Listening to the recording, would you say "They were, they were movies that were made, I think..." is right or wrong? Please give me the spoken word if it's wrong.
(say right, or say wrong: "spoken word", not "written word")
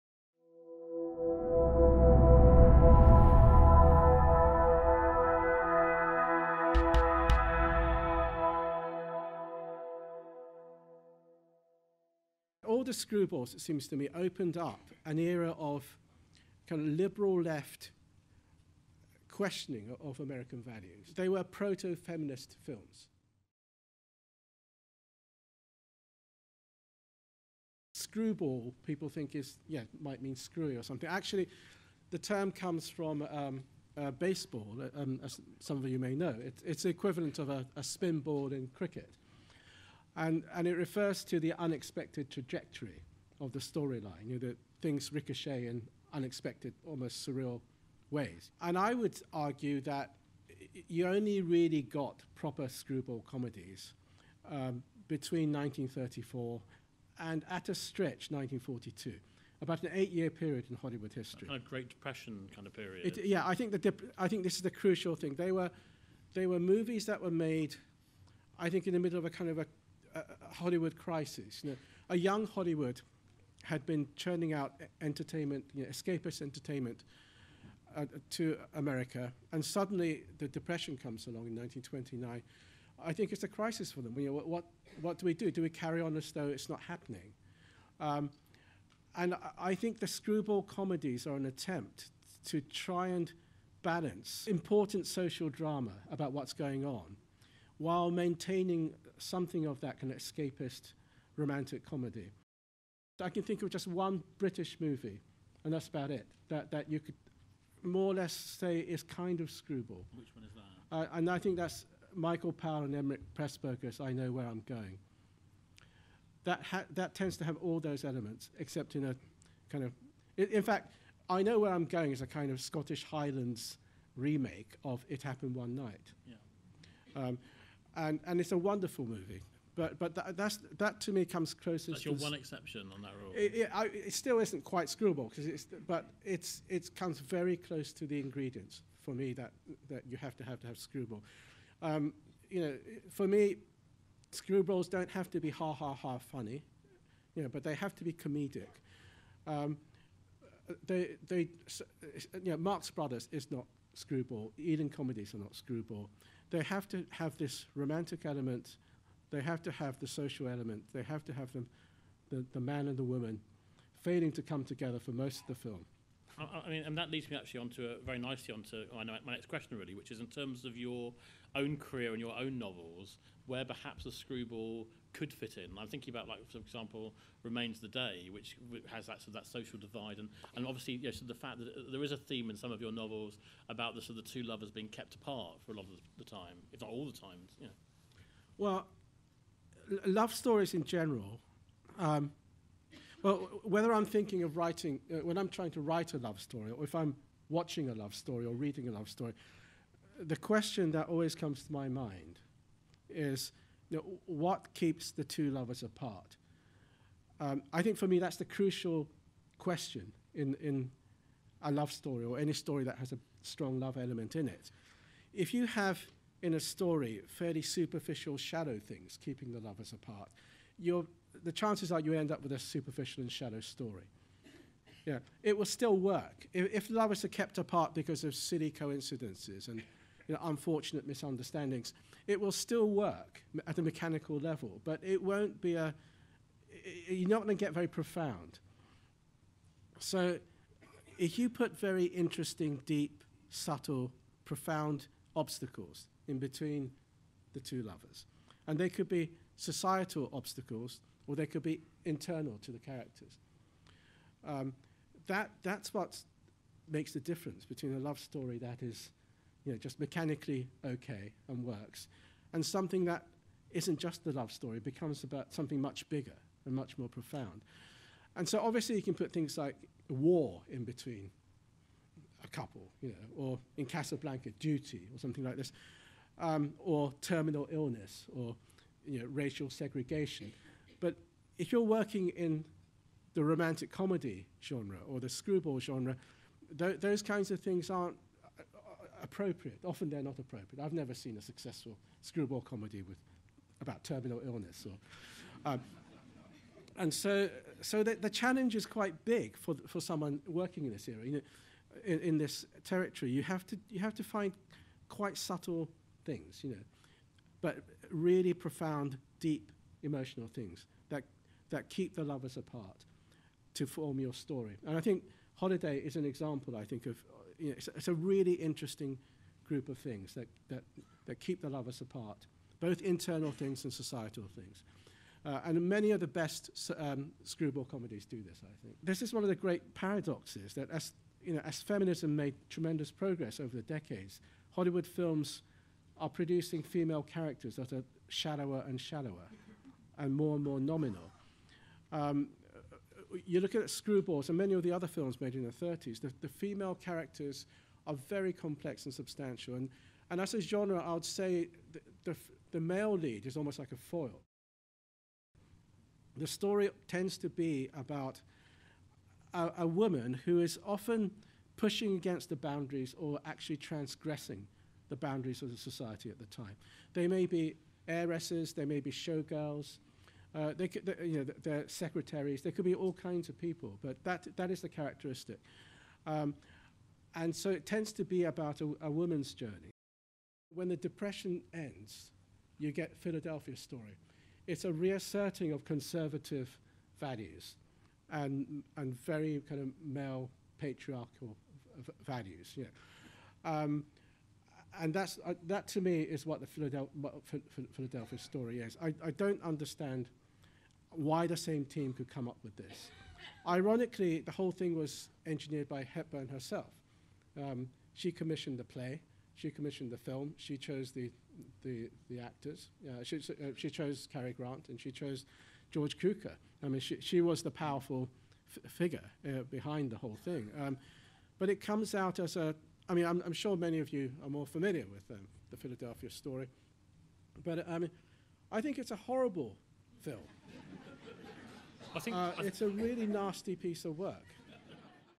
right.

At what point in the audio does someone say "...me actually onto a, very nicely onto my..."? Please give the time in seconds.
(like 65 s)
167 s.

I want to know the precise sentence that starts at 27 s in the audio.
Screwball, people think is, yeah, might mean screwy or something.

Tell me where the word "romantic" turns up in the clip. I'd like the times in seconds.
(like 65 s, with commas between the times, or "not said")
101 s, 157 s, 283 s.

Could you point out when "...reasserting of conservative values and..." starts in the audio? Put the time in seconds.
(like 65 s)
384 s.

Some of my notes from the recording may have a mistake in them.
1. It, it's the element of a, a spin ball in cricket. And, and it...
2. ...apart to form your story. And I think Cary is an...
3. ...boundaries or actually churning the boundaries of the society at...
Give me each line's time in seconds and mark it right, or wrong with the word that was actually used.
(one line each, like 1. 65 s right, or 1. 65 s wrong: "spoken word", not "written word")
1. 36 s wrong: "equivalent", not "element"
2. 312 s wrong: "Holiday", not "Cary"
3. 362 s wrong: "transgressing", not "churning".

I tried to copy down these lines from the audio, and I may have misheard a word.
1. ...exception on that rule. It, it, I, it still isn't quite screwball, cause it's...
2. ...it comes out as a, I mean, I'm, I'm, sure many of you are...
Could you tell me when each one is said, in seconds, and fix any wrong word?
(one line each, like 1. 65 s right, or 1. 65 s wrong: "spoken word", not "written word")
1. 132 s right
2. 421 s right.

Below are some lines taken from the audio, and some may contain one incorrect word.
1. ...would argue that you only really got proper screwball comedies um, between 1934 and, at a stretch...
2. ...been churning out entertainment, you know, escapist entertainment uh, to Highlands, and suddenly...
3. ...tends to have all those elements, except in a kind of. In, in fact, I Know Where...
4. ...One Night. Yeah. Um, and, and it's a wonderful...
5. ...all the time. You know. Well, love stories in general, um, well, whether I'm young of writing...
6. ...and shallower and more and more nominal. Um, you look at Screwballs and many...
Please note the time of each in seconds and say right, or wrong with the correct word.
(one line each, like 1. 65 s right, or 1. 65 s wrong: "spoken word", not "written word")
1. 48 s right
2. 73 s wrong: "America", not "Highlands"
3. 117 s right
4. 125 s right
5. 186 s wrong: "thinking", not "young"
6. 338 s right.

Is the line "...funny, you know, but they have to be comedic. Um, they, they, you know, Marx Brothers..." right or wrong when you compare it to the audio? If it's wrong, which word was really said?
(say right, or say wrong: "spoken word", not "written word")
right.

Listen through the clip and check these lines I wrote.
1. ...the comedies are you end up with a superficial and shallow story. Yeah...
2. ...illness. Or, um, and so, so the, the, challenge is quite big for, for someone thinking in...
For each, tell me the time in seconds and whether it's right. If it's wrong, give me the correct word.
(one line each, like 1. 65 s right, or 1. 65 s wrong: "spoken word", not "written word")
1. 221 s wrong: "chances", not "comedies"
2. 294 s wrong: "working", not "thinking".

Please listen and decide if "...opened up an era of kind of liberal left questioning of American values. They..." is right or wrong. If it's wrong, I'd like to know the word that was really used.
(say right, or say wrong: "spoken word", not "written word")
right.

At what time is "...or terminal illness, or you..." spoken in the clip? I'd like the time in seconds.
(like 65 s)
276 s.